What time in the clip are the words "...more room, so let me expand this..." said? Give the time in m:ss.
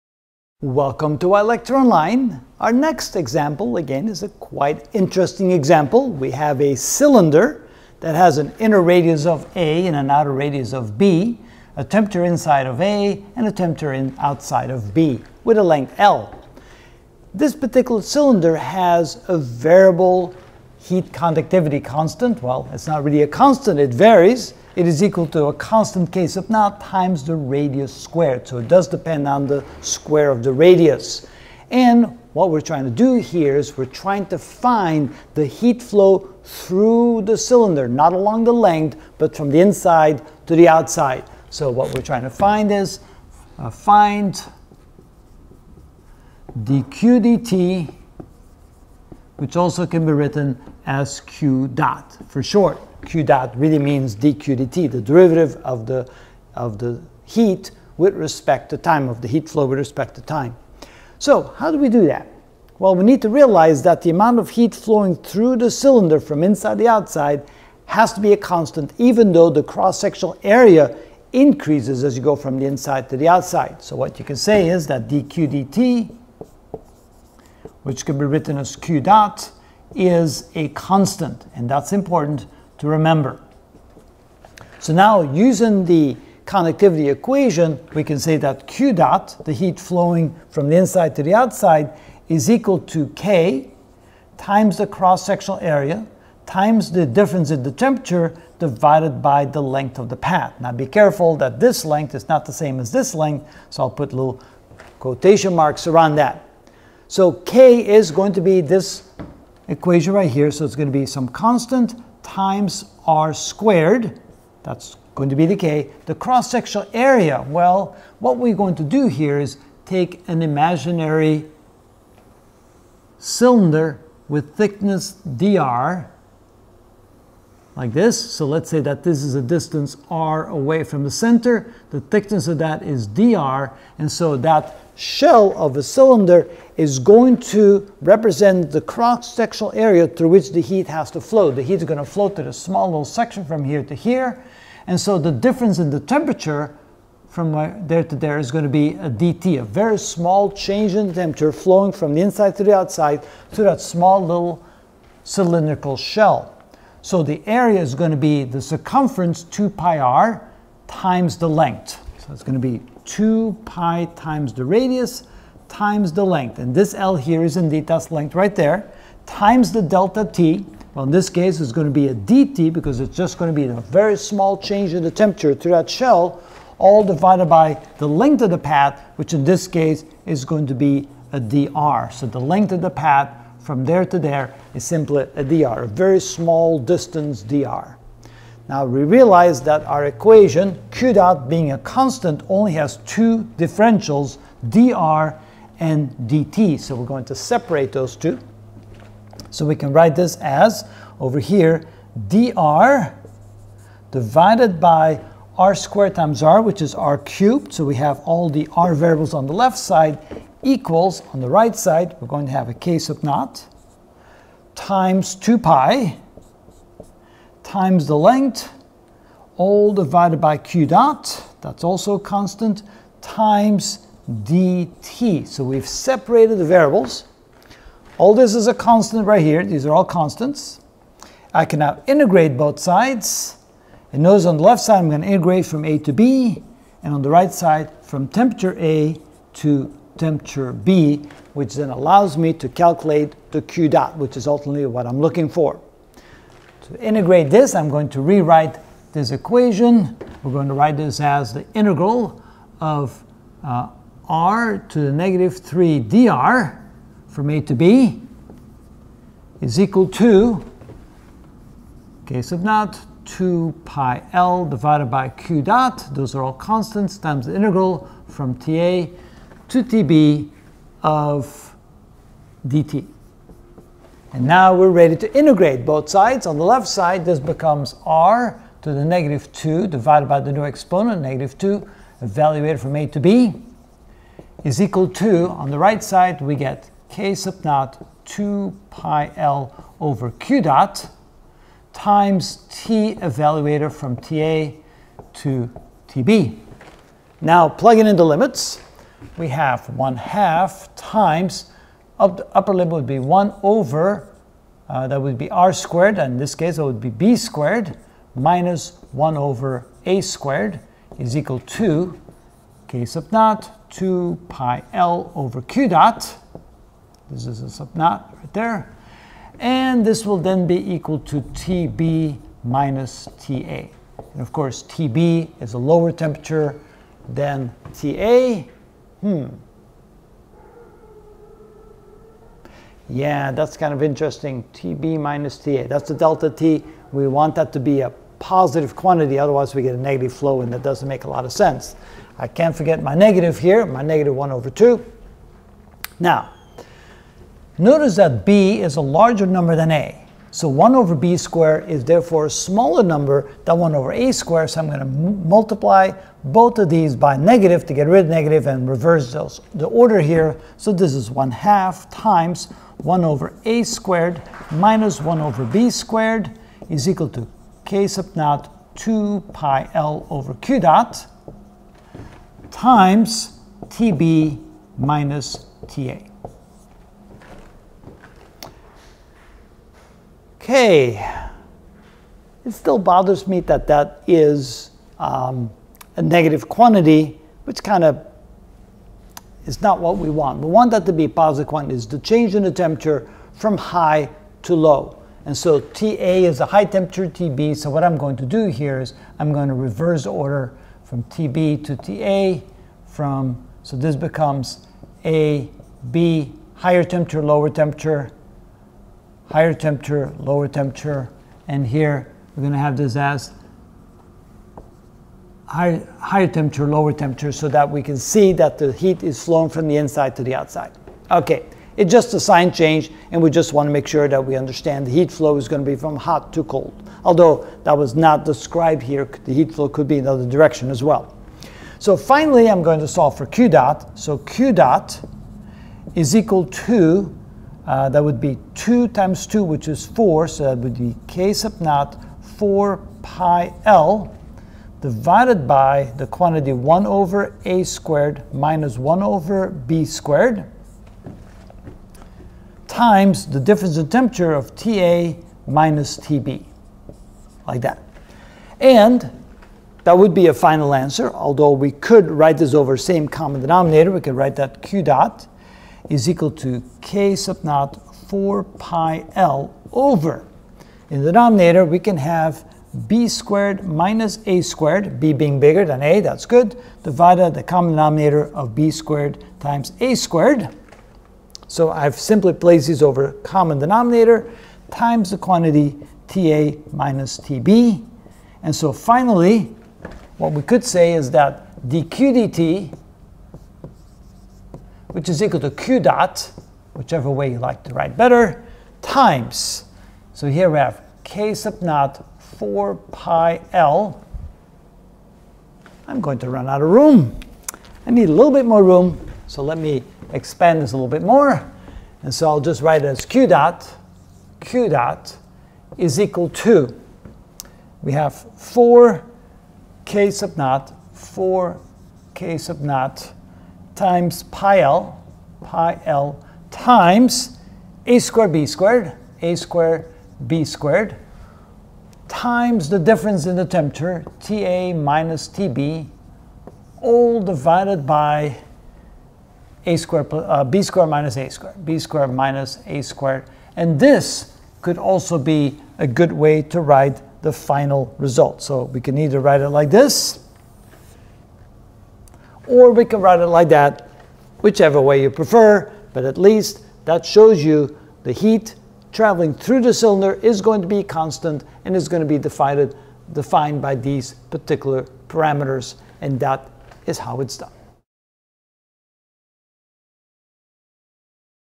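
8:28.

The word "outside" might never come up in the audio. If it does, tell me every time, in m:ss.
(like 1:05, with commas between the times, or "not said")
0:14, 0:40, 1:06, 1:13, 1:31, 2:32, 7:00.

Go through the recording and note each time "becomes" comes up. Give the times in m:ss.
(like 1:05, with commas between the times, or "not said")
4:37, 6:44.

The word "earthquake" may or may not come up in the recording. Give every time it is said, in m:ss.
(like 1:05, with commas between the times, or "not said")
not said.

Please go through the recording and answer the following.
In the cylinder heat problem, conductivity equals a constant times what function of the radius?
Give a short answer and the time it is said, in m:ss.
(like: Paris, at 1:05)
radius squared, at 0:27.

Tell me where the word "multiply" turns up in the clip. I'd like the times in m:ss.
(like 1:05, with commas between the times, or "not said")
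5:55.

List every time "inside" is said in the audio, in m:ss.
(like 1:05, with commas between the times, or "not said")
0:12, 0:39, 1:06, 1:12, 1:30, 2:32, 6:59.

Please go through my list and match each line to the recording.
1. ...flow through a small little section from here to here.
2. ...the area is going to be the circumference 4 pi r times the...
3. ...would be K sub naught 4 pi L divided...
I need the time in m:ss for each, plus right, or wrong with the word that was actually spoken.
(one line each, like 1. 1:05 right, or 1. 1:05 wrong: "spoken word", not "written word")
1. 2:22 right
2. 2:37 wrong: "2", not "4"
3. 7:20 right.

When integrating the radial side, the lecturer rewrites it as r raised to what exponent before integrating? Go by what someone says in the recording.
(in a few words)
negative 3.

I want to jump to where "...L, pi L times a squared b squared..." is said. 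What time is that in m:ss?
8:44.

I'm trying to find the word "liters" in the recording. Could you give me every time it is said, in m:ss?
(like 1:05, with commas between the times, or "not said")
not said.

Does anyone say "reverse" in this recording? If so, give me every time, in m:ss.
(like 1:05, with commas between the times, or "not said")
5:58, 6:39.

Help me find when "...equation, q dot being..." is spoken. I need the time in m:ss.
3:10.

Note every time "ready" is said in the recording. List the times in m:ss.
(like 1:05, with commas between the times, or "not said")
4:34.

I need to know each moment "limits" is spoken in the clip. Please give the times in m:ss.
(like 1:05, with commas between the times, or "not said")
4:58, 5:02.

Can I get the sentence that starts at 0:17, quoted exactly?
This particular cylinder has a variable heat conductivity constant?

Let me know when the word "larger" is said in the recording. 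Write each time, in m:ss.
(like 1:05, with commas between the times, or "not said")
5:49.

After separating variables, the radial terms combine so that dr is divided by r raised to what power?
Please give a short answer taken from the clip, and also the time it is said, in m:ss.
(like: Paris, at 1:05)
r cubed, at 3:26.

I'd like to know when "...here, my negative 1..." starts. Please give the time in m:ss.
5:43.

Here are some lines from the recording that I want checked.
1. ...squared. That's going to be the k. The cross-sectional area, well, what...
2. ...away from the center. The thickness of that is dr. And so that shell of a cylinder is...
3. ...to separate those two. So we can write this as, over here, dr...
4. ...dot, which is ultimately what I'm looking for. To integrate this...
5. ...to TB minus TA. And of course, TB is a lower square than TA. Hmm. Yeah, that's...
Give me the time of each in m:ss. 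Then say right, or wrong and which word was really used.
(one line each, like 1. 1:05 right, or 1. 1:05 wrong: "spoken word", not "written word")
1. 1:53 right
2. 2:10 right
3. 3:17 right
4. 4:03 right
5. 5:21 wrong: "temperature", not "square".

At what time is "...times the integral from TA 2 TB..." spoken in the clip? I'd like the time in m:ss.
4:27.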